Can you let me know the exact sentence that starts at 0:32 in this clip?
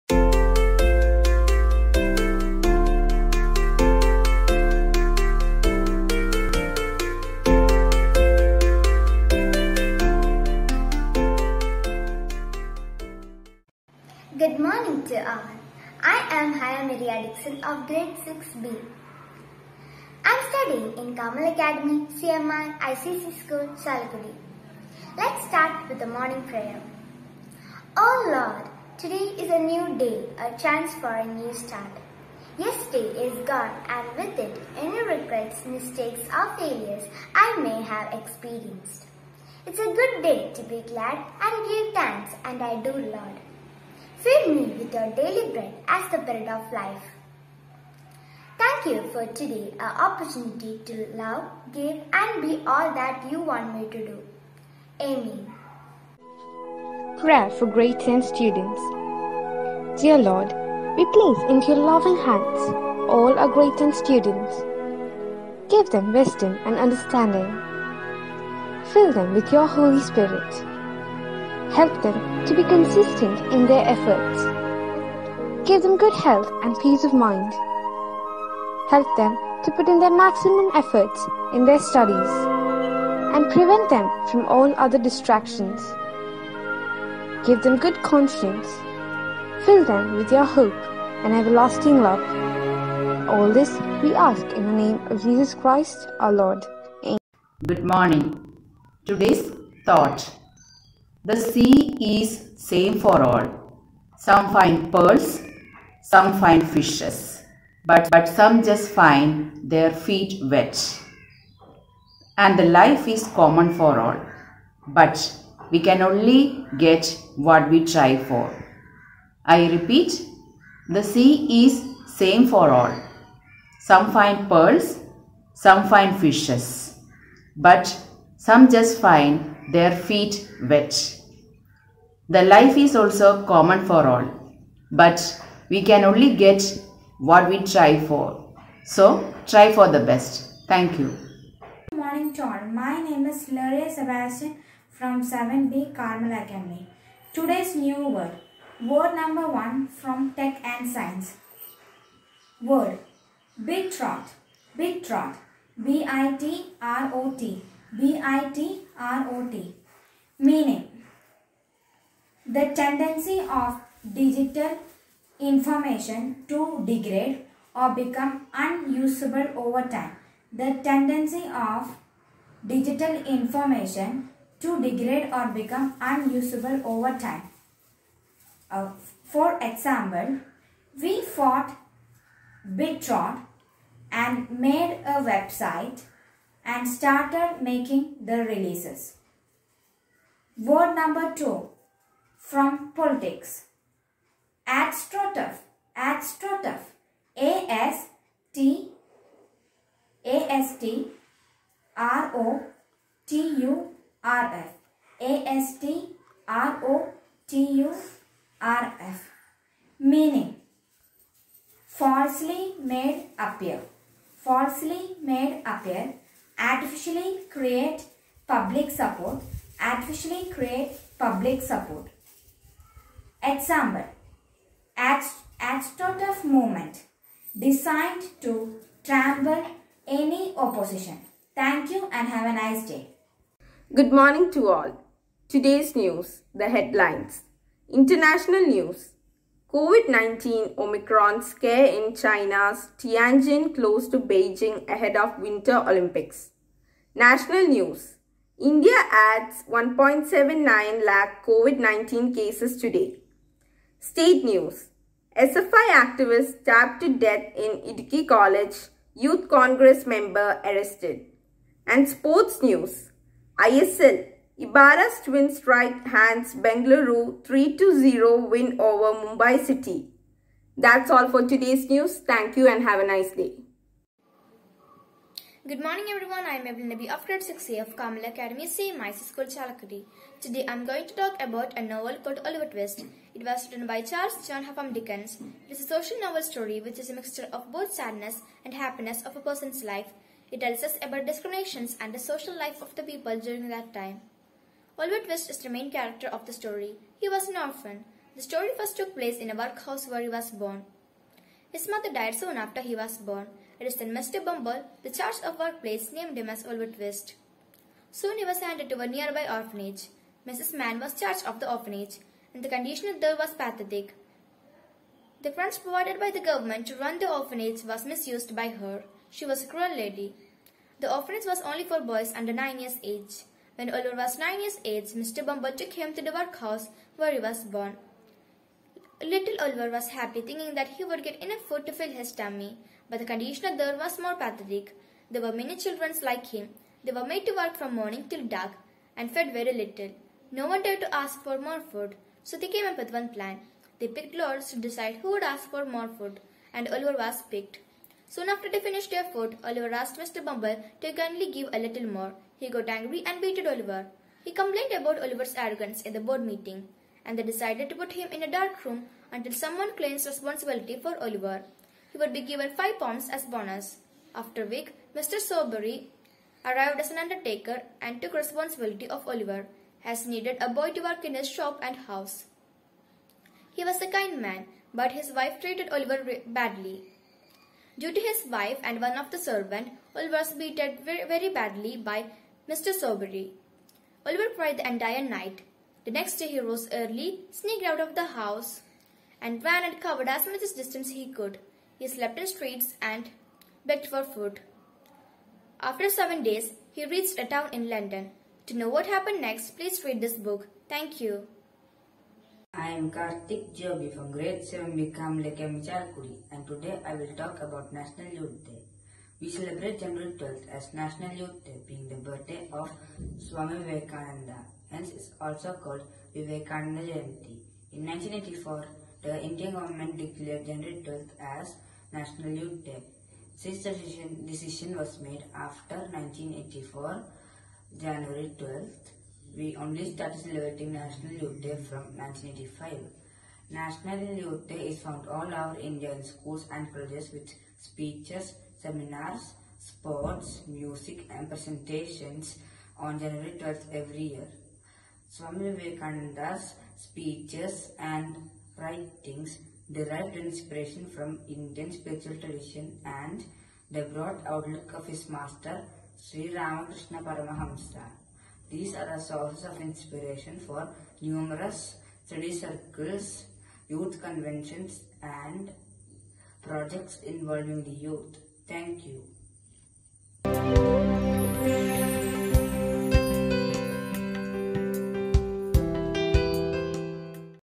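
Yesterday is gone and with it any regrets, mistakes or failures I may have experienced.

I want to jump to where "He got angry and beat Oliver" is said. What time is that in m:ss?
5:52.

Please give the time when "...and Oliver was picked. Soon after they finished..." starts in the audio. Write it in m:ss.
5:46.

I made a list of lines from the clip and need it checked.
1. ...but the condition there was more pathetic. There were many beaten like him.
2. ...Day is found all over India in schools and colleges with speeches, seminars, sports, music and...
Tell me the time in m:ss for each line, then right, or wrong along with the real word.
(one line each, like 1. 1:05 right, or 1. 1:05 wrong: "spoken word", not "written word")
1. 5:33 wrong: "children", not "beaten"
2. 7:14 right.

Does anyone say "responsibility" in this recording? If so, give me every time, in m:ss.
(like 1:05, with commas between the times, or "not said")
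6:00, 6:08.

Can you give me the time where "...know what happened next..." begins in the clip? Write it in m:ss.
6:38.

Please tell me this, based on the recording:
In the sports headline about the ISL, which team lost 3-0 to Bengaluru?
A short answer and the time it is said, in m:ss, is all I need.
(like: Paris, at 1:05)
Mumbai City, at 4:29.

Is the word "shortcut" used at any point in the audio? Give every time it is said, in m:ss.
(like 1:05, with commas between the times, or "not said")
not said.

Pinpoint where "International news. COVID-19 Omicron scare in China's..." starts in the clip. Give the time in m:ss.
3:57.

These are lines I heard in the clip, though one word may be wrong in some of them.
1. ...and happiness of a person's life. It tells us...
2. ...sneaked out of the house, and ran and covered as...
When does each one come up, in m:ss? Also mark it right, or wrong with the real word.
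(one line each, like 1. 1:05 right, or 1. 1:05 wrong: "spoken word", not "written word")
1. 4:48 right
2. 6:27 right.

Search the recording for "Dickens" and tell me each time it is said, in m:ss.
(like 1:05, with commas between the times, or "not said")
4:44.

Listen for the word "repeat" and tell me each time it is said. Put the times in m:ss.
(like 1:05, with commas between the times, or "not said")
1:59.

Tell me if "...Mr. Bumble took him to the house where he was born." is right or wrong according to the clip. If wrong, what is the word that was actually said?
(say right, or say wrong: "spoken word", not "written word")
wrong: "workhouse", not "house".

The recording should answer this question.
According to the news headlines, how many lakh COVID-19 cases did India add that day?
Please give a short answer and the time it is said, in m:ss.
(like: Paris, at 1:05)
1.79 lakh, at 4:09.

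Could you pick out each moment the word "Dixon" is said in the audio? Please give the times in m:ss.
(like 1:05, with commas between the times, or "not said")
0:17.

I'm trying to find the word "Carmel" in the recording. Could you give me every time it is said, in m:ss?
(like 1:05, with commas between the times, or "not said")
0:21, 2:25, 4:37.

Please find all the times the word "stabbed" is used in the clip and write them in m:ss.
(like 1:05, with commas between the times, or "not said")
4:16.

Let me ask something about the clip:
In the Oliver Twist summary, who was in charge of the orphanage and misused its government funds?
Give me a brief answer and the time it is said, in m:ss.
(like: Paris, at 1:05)
Mrs. Mann, at 5:10.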